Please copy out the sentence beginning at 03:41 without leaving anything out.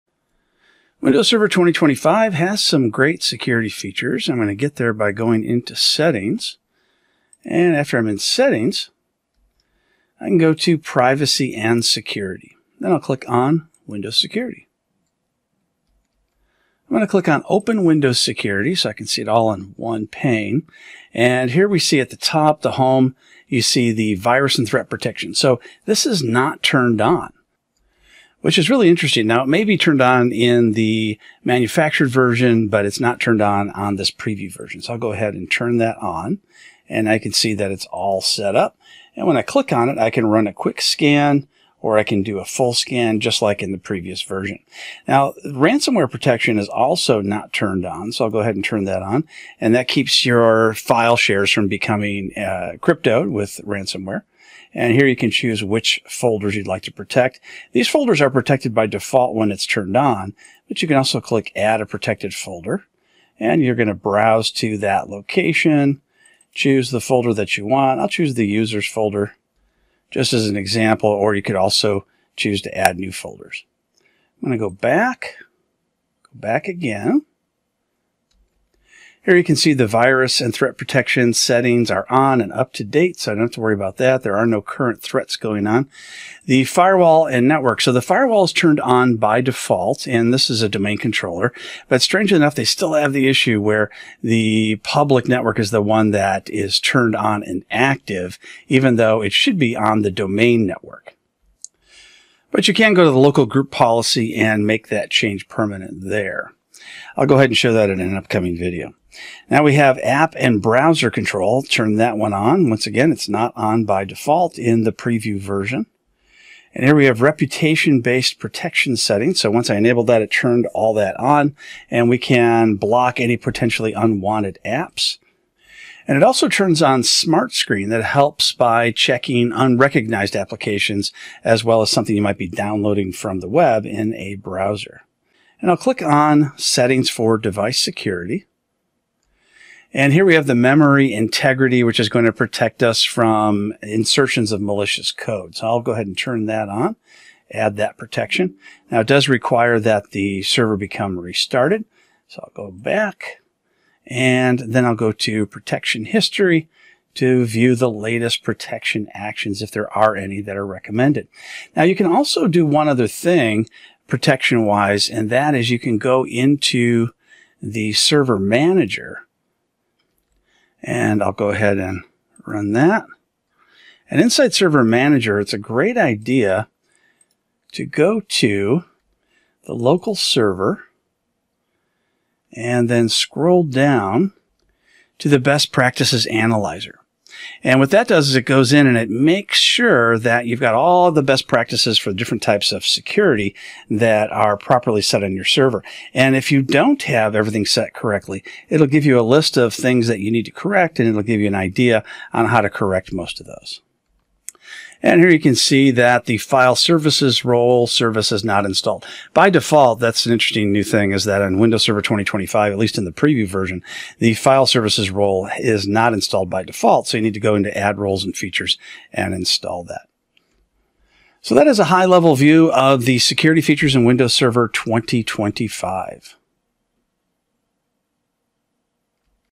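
So that is a high level view of the security features in Windows Server 2025.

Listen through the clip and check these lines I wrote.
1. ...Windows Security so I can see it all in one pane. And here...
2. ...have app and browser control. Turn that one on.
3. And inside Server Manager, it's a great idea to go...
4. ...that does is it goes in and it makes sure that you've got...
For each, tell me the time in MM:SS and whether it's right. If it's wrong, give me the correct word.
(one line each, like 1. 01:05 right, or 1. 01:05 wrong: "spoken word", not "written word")
1. 00:17 right
2. 01:49 right
3. 02:54 right
4. 03:07 right.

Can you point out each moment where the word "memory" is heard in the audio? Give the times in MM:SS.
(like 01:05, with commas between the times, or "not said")
02:20.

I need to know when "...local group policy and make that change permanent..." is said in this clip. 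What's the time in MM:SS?
01:43.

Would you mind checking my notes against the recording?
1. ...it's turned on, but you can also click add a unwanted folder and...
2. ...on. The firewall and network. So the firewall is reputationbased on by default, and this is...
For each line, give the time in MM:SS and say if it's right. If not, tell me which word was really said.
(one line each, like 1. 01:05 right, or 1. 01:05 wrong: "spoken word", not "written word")
1. 00:59 wrong: "protected", not "unwanted"
2. 01:25 wrong: "turned", not "reputationbased".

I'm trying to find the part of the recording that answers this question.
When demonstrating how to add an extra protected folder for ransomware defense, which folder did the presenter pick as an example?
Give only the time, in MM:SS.
01:08.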